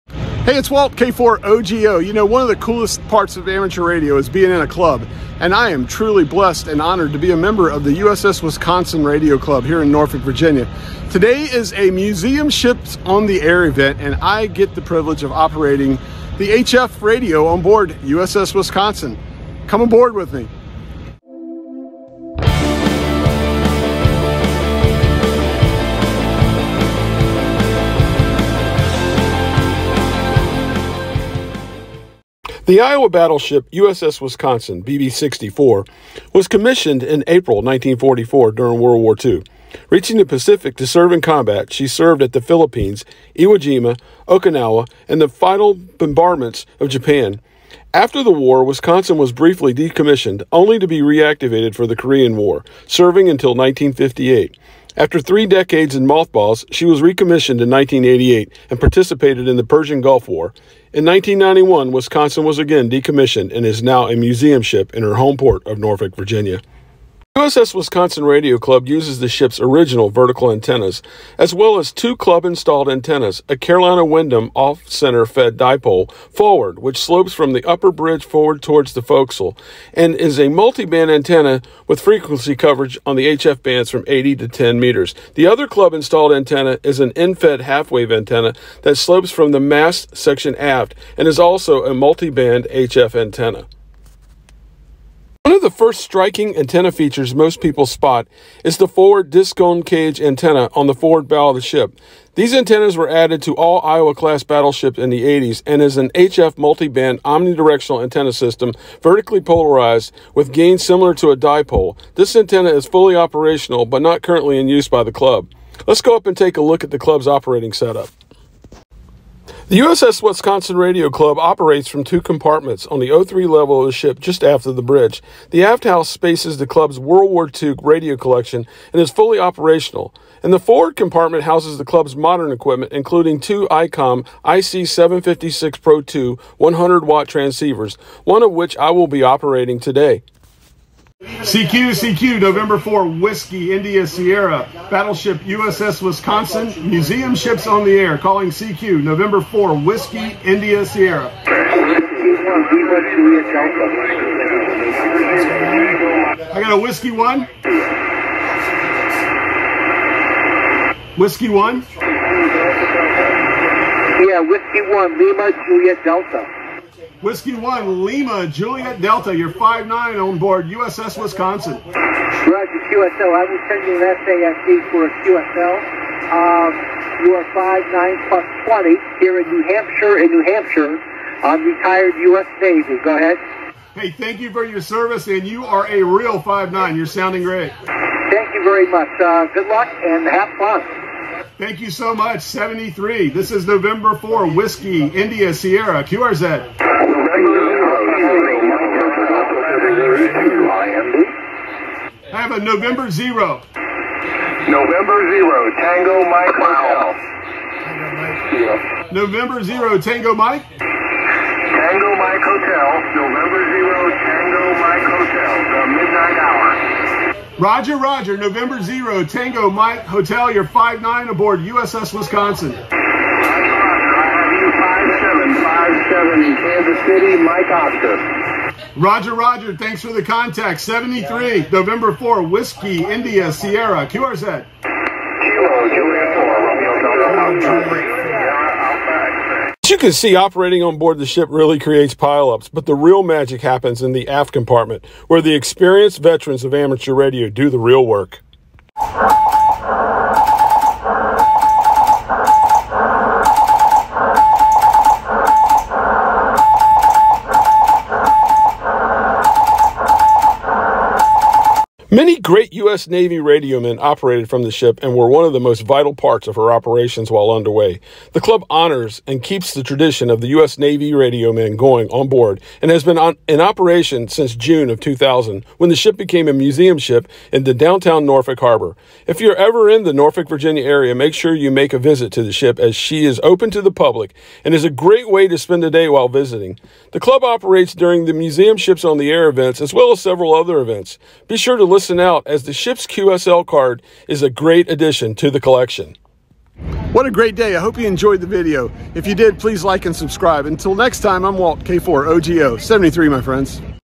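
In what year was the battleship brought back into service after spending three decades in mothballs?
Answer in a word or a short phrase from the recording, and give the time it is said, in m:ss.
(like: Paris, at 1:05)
1988, at 0:57.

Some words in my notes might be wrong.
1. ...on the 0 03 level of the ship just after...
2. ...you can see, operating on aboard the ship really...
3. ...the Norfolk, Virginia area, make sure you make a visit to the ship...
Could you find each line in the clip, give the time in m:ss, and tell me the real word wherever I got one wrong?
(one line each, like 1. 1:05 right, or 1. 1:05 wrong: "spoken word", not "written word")
1. 2:02 right
2. 3:59 wrong: "board", not "aboard"
3. 4:40 right.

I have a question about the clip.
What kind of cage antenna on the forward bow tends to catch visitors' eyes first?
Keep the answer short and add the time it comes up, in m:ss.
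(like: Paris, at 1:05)
Discone, at 1:39.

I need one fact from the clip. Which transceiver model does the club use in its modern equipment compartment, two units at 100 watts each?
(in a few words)
ICOM IC756 Pro 2.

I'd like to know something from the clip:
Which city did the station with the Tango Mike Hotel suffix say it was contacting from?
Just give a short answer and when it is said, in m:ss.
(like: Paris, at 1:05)
Kansas City, at 3:46.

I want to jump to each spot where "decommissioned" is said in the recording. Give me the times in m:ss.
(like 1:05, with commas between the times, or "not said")
0:49, 1:02.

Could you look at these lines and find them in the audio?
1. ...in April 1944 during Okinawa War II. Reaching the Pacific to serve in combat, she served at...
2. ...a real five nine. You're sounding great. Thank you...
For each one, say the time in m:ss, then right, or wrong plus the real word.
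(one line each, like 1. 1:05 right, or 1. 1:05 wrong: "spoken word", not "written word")
1. 0:37 wrong: "World", not "Okinawa"
2. 3:05 right.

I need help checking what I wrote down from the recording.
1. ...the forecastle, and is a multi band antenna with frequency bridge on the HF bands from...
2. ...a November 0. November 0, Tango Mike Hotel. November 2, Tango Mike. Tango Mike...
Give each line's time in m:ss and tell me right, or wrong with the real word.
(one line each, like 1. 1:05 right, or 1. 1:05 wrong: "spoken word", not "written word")
1. 1:18 wrong: "coverage", not "bridge"
2. 3:22 wrong: "0", not "2".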